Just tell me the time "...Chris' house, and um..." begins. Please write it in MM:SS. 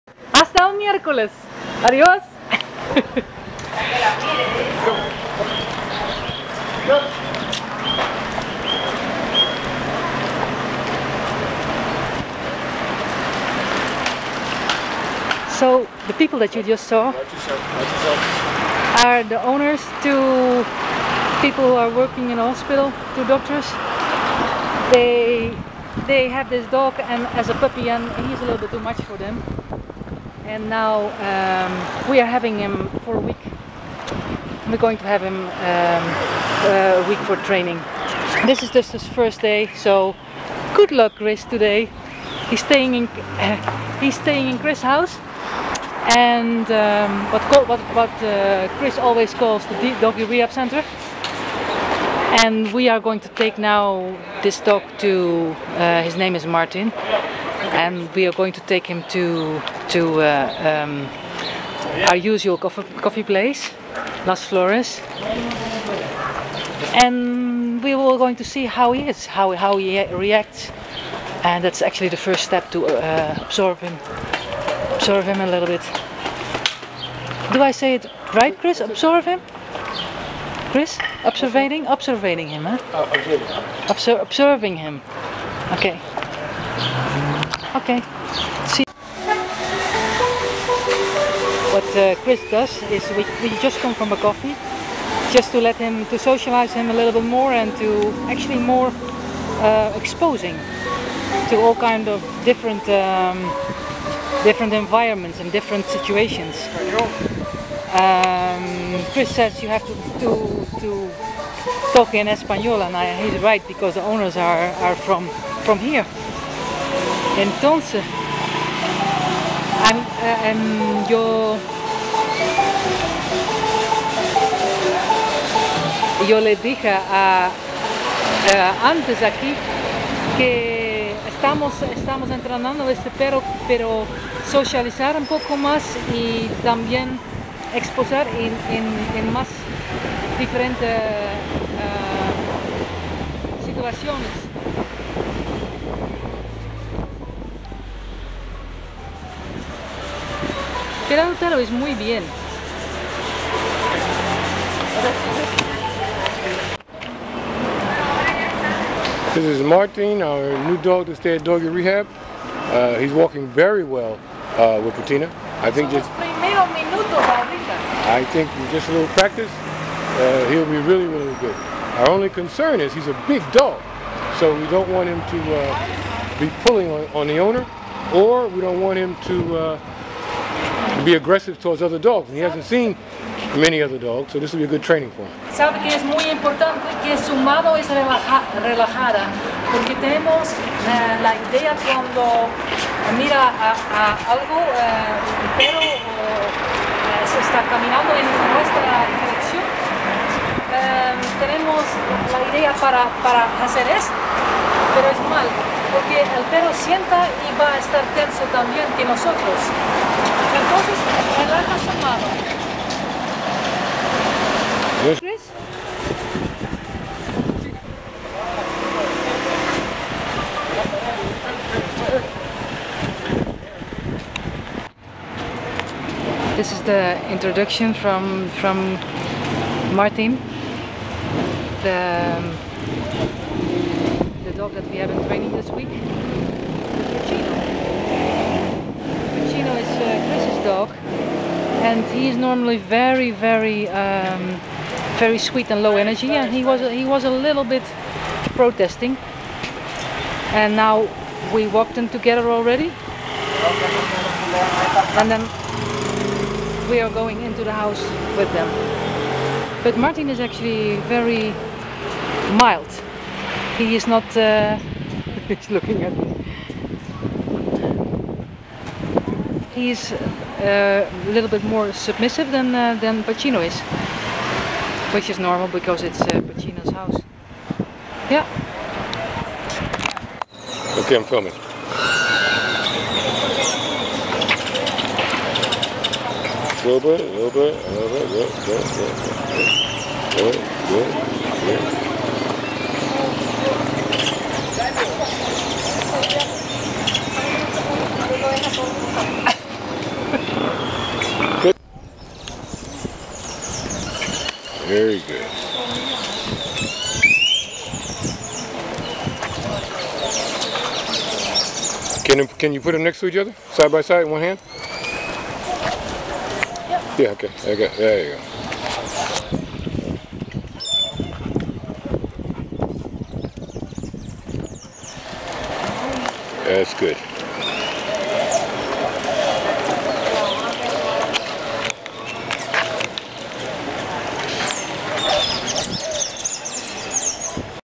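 00:44.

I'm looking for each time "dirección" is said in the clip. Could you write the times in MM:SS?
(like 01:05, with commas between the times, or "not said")
03:19.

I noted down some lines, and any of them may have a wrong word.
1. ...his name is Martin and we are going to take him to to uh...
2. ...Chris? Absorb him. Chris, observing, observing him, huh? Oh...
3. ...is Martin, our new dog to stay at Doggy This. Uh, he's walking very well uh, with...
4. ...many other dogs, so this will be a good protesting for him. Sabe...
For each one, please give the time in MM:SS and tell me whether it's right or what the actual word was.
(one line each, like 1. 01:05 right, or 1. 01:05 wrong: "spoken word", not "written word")
1. 00:56 right
2. 01:18 right
3. 02:39 wrong: "Rehab", not "This"
4. 03:03 wrong: "training", not "protesting".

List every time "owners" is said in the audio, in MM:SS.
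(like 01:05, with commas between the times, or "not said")
00:19, 01:54, 02:57.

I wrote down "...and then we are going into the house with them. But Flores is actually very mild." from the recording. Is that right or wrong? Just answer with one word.
wrong.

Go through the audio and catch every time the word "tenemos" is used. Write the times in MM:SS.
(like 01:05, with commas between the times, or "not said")
03:09, 03:21.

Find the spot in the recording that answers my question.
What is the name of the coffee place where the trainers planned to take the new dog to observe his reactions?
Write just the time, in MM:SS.
01:04.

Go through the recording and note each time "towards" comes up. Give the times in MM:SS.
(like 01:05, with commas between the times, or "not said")
03:01.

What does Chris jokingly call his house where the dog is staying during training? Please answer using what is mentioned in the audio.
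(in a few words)
doggy rehab center.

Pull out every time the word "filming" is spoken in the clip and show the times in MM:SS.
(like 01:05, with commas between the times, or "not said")
04:41.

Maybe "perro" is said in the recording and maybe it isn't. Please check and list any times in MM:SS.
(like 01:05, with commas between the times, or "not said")
02:13, 03:15, 03:26.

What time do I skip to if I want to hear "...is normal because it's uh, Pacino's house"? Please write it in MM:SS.
04:35.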